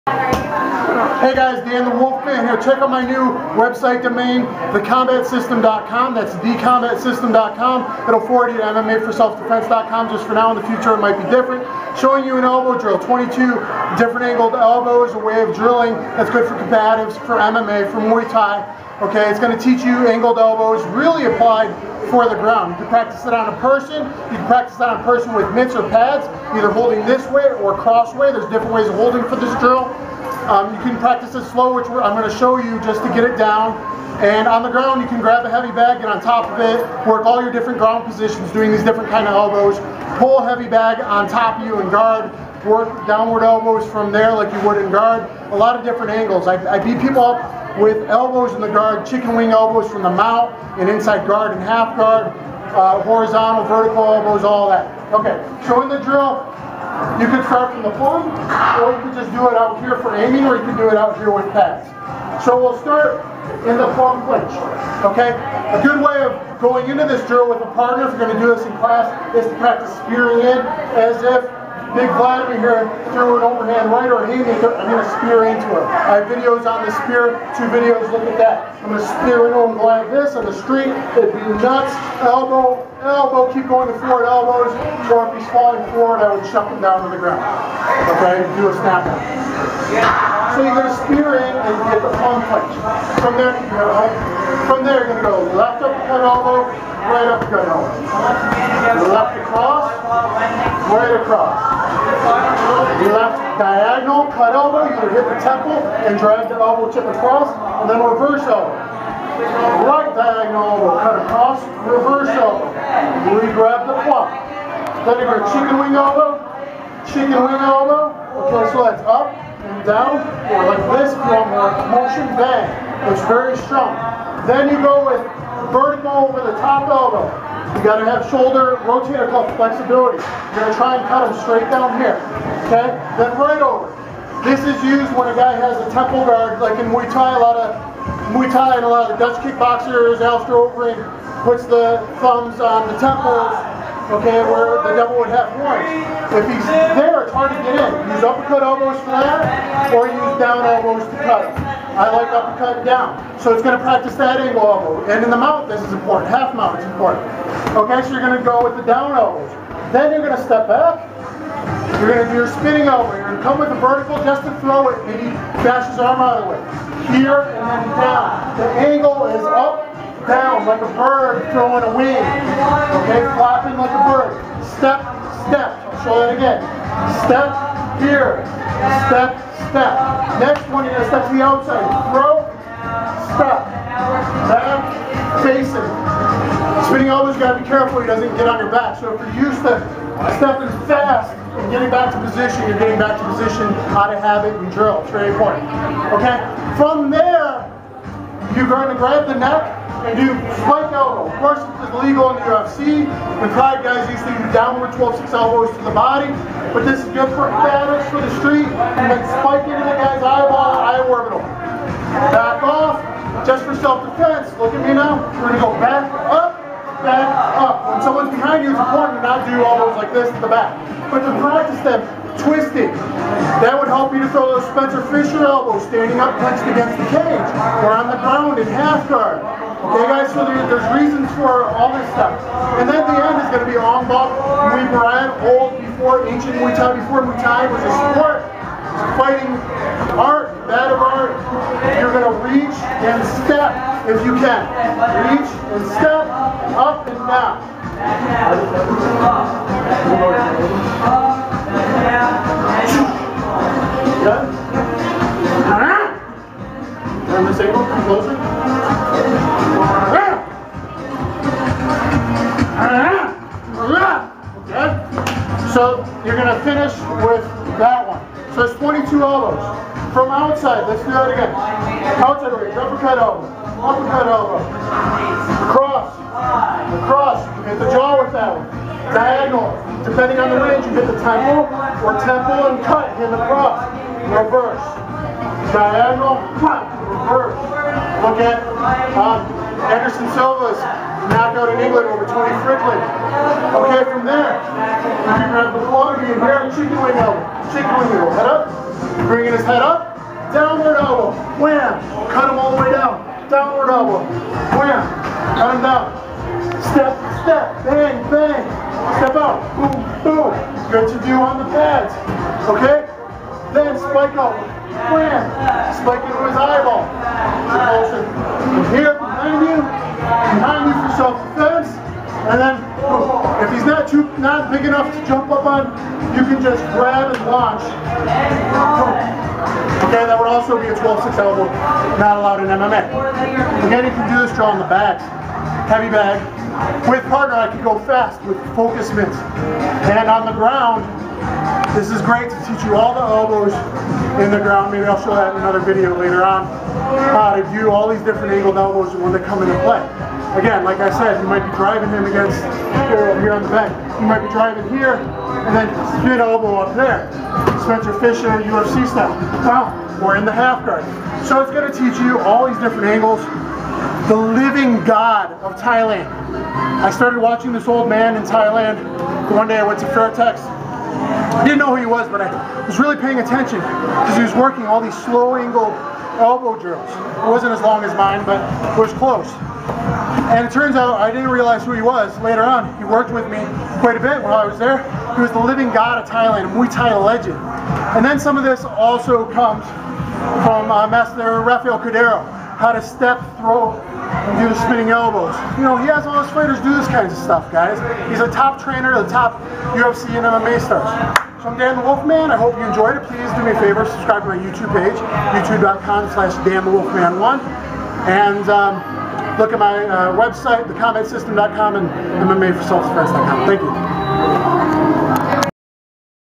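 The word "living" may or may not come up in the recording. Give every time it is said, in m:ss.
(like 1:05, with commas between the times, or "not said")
6:04, 6:25.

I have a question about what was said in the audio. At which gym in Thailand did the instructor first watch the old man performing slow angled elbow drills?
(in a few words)
Fairtex.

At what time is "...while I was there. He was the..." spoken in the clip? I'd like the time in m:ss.
6:24.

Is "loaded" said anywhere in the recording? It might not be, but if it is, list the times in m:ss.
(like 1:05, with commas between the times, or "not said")
not said.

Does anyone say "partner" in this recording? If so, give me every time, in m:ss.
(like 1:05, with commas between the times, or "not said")
1:07, 5:37.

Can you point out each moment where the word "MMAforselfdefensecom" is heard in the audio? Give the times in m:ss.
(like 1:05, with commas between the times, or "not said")
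0:08, 6:52.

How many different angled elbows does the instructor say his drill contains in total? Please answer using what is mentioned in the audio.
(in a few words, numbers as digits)
22.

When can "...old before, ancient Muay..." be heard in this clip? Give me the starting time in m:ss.
3:55.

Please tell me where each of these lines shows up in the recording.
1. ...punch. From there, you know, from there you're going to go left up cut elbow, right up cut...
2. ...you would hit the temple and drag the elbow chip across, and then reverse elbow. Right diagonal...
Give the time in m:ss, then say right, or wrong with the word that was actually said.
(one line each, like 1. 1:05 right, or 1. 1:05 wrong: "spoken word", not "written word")
1. 1:32 right
2. 1:44 right.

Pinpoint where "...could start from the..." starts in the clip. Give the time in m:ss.
0:57.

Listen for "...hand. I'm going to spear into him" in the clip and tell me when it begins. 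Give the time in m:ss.
1:14.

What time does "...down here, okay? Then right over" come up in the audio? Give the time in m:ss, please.
2:11.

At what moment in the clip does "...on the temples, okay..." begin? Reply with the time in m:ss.
2:22.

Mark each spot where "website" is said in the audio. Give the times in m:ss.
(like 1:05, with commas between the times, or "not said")
0:03, 6:50.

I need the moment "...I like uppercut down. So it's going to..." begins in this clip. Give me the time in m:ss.
2:31.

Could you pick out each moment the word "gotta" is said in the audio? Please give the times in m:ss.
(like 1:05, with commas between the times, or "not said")
2:07, 3:07.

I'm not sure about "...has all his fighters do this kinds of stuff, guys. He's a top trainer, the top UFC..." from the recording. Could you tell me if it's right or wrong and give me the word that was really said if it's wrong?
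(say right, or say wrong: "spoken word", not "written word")
right.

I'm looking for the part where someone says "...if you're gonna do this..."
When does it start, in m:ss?
1:08.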